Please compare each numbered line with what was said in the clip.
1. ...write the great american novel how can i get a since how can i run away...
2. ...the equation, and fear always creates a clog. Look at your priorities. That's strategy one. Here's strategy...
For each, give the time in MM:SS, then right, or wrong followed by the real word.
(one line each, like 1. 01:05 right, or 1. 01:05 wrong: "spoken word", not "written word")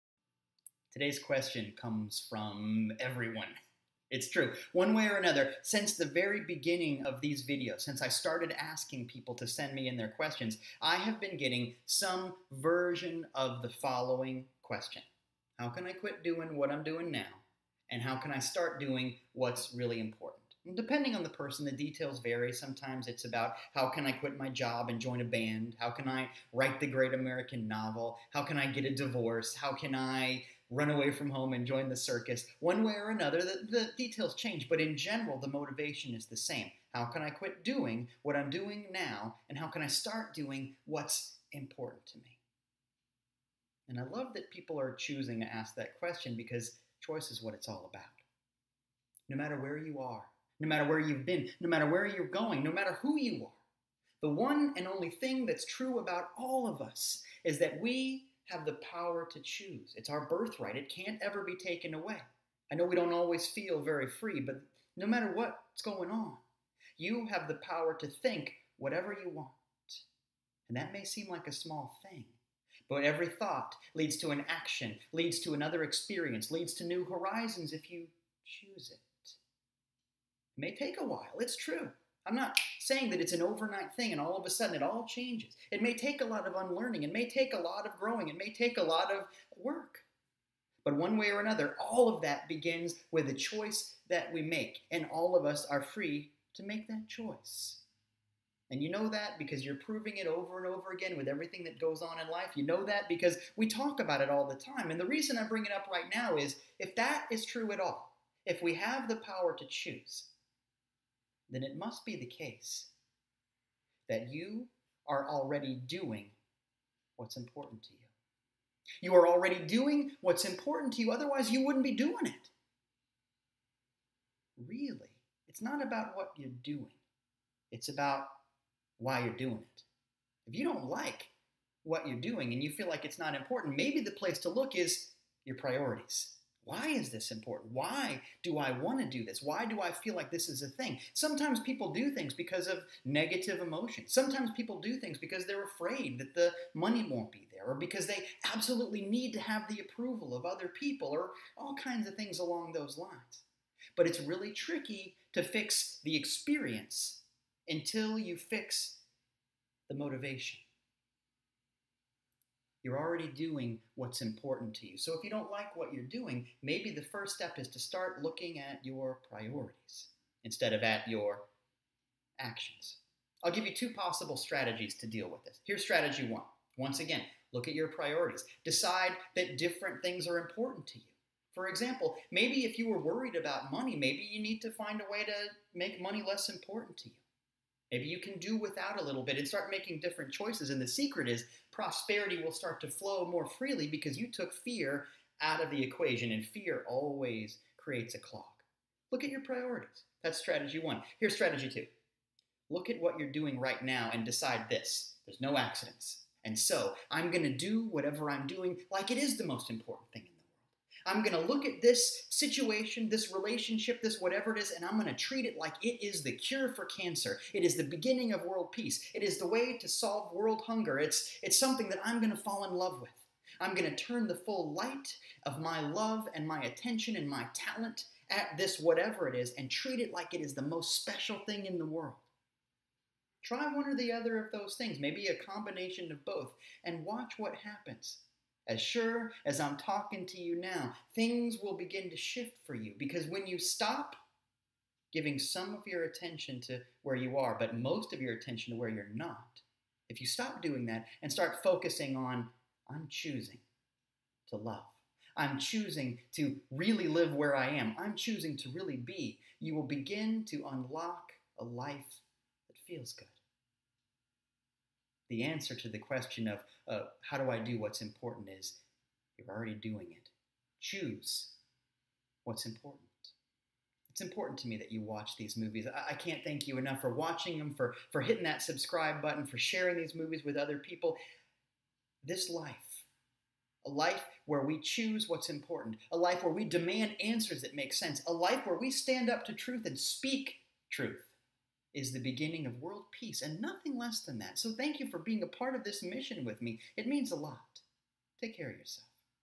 1. 00:26 wrong: "divorce", not "since"
2. 03:15 right.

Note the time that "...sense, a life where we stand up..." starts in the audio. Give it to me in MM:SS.
04:47.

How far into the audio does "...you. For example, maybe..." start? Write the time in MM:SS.
03:00.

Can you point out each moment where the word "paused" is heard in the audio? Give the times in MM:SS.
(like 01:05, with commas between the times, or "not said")
not said.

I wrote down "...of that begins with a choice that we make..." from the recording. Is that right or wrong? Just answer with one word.
right.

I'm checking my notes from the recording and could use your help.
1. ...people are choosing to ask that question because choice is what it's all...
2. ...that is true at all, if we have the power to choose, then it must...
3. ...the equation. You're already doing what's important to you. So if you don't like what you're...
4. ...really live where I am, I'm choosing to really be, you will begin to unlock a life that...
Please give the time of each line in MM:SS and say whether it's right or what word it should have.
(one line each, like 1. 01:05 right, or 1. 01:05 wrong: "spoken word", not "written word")
1. 00:44 right
2. 01:46 right
3. 02:39 wrong: "motivation", not "equation"
4. 04:16 right.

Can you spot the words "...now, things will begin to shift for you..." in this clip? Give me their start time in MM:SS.
04:00.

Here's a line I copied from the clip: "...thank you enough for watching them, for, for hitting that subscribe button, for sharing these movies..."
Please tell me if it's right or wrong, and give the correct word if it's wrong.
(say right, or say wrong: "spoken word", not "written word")
right.